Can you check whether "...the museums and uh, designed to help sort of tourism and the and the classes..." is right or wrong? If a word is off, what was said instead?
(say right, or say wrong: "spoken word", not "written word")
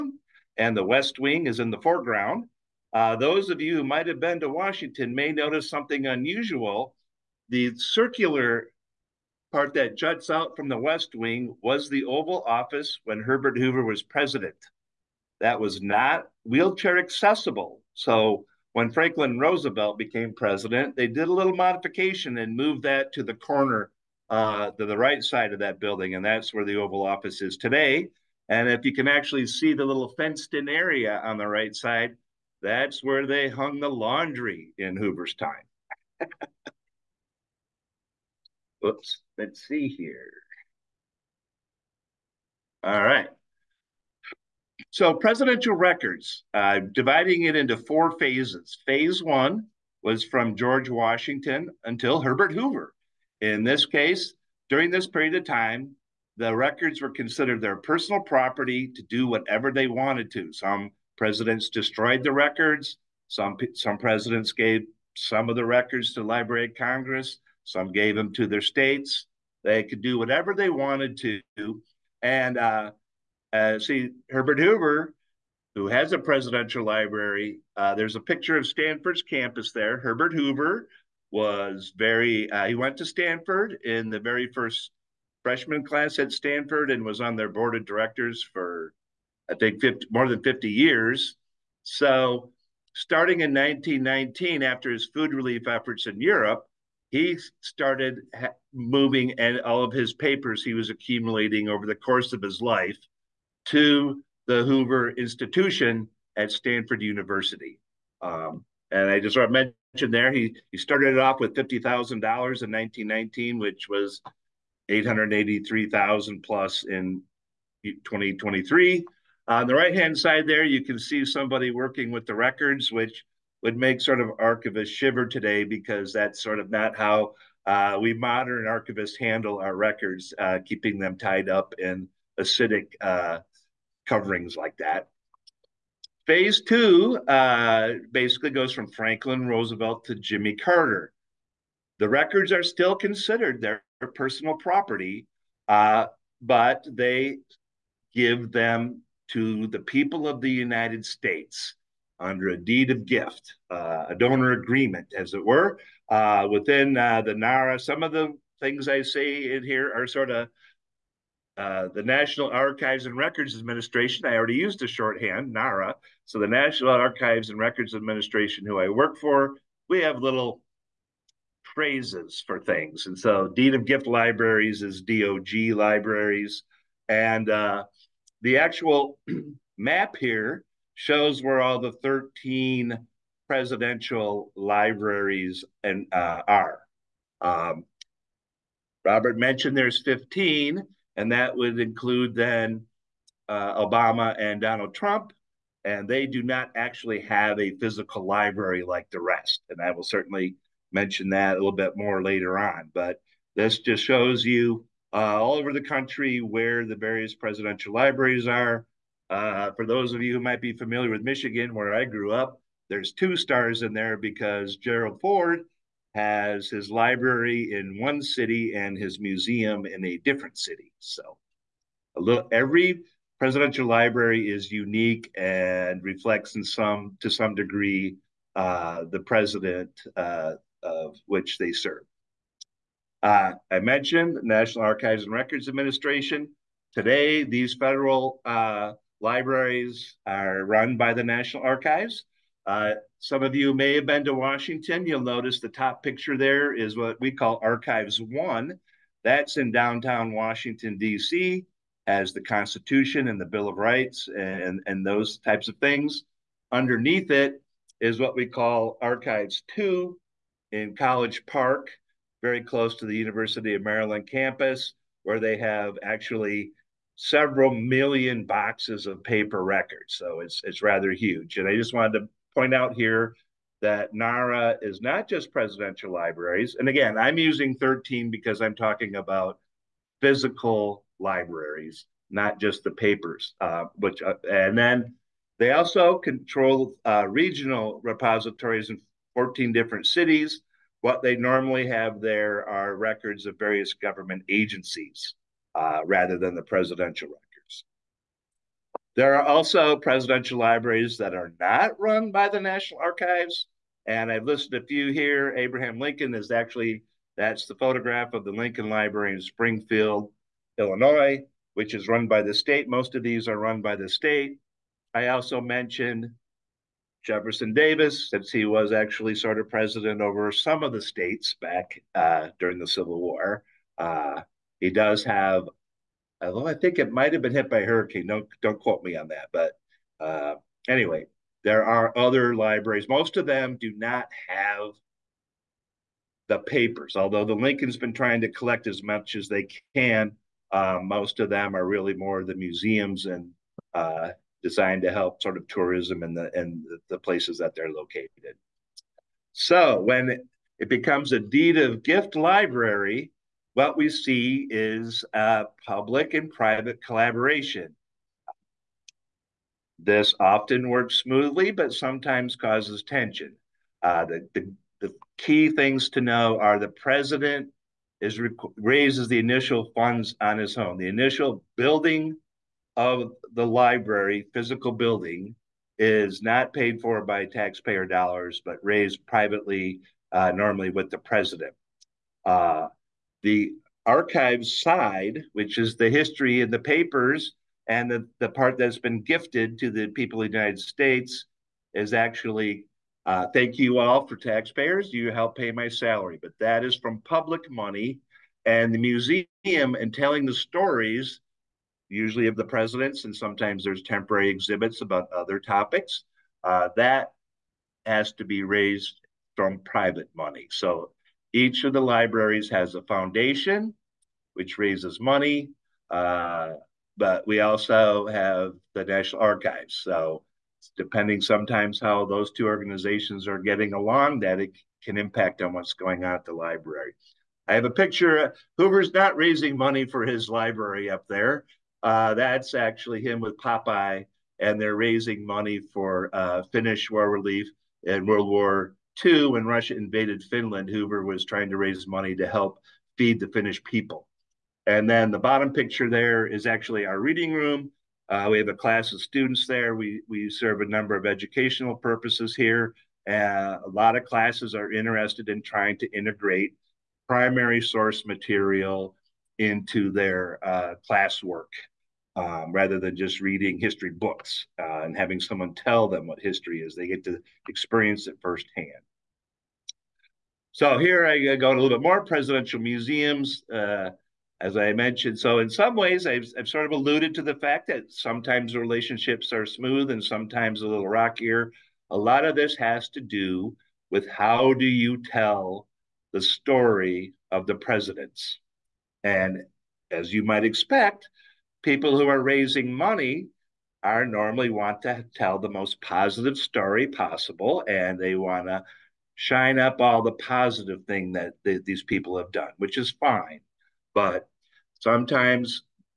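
wrong: "places", not "classes".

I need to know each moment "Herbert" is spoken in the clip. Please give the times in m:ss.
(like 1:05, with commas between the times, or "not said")
0:13, 0:52, 1:14, 1:19.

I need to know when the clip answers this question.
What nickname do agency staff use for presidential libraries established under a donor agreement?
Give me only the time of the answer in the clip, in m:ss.
2:55.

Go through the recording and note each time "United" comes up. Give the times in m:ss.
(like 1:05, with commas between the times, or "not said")
2:30, 6:30.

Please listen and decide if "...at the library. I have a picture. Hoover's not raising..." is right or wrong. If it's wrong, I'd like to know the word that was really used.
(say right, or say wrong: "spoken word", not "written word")
right.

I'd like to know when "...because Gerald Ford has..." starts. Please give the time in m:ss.
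3:34.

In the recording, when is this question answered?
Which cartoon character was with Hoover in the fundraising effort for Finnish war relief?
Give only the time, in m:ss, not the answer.
7:13.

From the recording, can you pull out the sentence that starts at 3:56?
Today, these federal uh, Libraries are run by the National Archives.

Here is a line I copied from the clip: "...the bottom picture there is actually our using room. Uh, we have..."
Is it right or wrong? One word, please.
wrong.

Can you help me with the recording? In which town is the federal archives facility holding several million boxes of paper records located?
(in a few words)
College Park.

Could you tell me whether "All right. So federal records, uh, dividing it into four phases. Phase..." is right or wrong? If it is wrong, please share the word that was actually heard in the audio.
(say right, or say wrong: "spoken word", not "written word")
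wrong: "presidential", not "federal".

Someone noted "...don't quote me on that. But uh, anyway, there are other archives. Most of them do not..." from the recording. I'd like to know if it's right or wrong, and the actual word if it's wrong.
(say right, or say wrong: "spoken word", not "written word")
wrong: "libraries", not "archives".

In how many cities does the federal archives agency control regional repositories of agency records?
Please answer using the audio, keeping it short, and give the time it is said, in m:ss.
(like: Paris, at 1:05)
14, at 4:49.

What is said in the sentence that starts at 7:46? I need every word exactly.
They get to experience it firsthand.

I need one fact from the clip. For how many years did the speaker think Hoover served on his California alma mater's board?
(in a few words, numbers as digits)
more than 50.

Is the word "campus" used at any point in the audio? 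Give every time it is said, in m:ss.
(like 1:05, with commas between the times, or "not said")
1:19, 4:24.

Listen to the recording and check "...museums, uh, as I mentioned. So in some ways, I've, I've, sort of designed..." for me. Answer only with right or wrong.
wrong.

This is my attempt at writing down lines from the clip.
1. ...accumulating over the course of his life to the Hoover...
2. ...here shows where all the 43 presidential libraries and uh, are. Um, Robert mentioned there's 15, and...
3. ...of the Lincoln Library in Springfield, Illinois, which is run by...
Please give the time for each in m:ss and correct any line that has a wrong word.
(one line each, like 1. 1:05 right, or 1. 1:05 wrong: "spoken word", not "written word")
1. 1:40 right
2. 3:00 wrong: "13", not "43"
3. 5:08 right.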